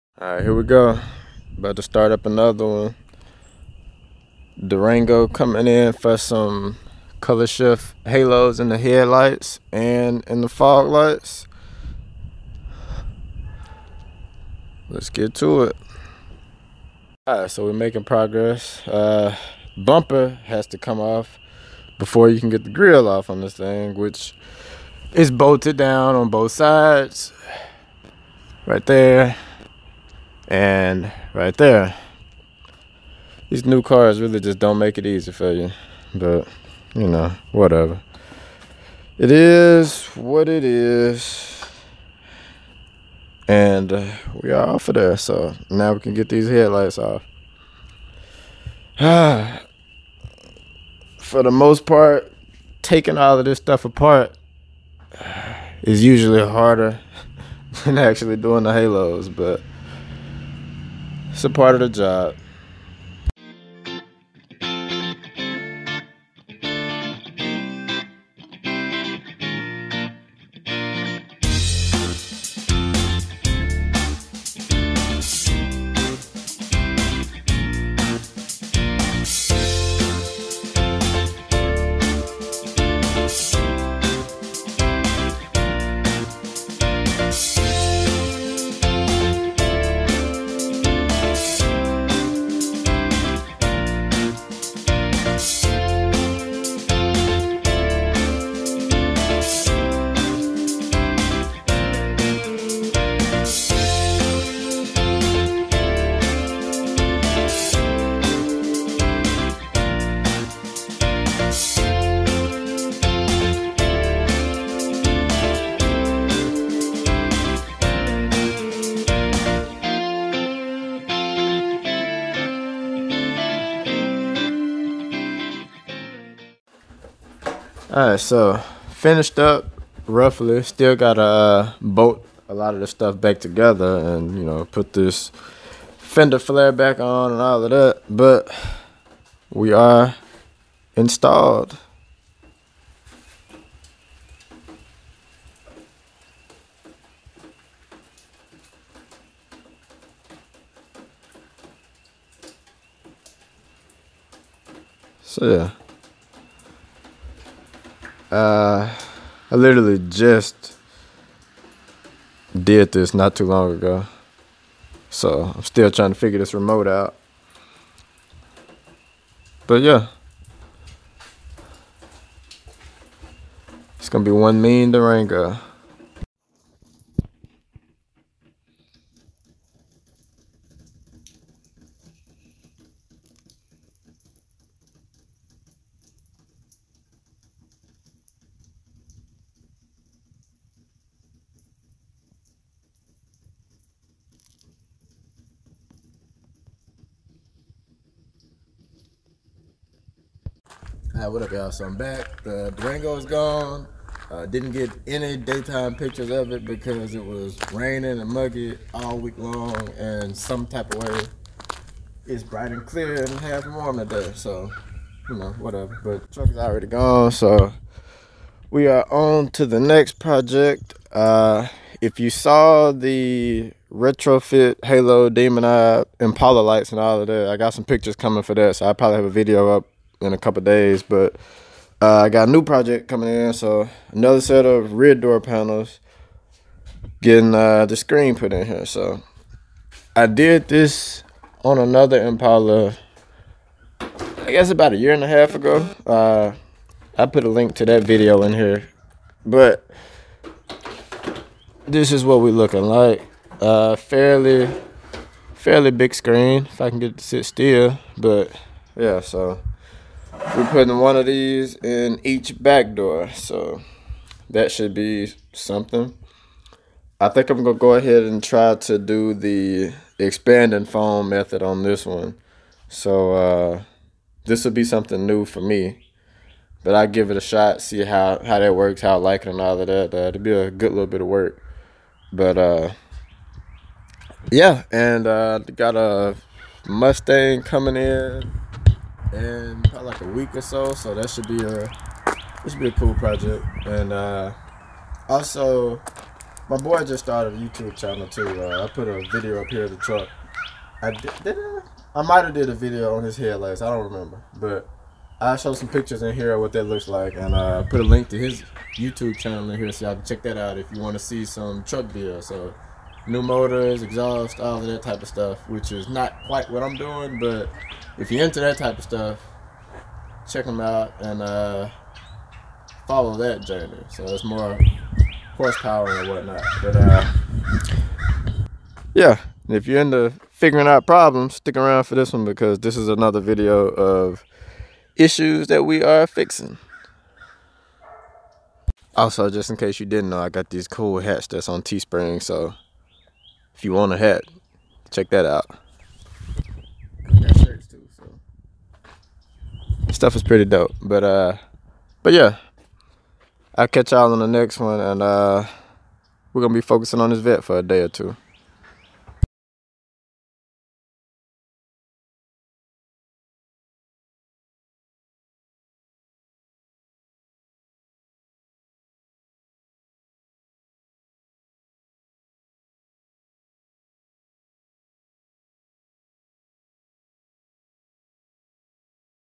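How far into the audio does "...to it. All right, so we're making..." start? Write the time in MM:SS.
00:15.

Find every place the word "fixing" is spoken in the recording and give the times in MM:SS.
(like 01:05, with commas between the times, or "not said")
05:36.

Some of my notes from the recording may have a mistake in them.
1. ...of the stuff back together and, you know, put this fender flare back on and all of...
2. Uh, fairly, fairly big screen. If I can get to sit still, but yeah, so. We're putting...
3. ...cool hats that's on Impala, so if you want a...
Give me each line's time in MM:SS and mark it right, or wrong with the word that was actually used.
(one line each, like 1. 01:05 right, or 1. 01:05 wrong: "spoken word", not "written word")
1. 02:12 right
2. 04:13 right
3. 05:40 wrong: "Teespring", not "Impala".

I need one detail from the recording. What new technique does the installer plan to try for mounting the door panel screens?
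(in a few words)
Expanding foam method.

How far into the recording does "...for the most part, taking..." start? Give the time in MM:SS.
00:51.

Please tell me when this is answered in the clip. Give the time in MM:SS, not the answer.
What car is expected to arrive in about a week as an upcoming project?
04:46.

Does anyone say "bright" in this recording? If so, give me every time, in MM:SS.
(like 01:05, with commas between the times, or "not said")
03:32.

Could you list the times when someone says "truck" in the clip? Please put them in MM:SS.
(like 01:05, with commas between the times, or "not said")
03:36, 04:59, 05:11.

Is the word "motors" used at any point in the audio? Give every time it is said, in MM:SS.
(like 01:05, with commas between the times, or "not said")
05:13.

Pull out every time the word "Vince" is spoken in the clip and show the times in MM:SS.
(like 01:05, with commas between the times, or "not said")
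not said.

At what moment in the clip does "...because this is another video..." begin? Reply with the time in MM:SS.
05:32.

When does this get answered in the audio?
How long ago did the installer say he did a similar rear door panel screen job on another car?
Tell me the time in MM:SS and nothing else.
04:04.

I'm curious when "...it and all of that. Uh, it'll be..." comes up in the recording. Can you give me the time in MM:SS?
04:39.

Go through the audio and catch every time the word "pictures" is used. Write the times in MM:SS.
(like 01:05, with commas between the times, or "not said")
03:25, 03:47, 05:05.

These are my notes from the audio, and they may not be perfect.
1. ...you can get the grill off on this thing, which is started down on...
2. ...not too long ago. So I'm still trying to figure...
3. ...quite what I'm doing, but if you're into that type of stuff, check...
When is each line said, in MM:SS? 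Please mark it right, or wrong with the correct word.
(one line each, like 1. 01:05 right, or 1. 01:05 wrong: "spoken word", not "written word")
1. 00:22 wrong: "bolted", not "started"
2. 02:43 right
3. 05:16 right.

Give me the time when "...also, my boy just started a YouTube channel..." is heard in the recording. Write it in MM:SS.
04:55.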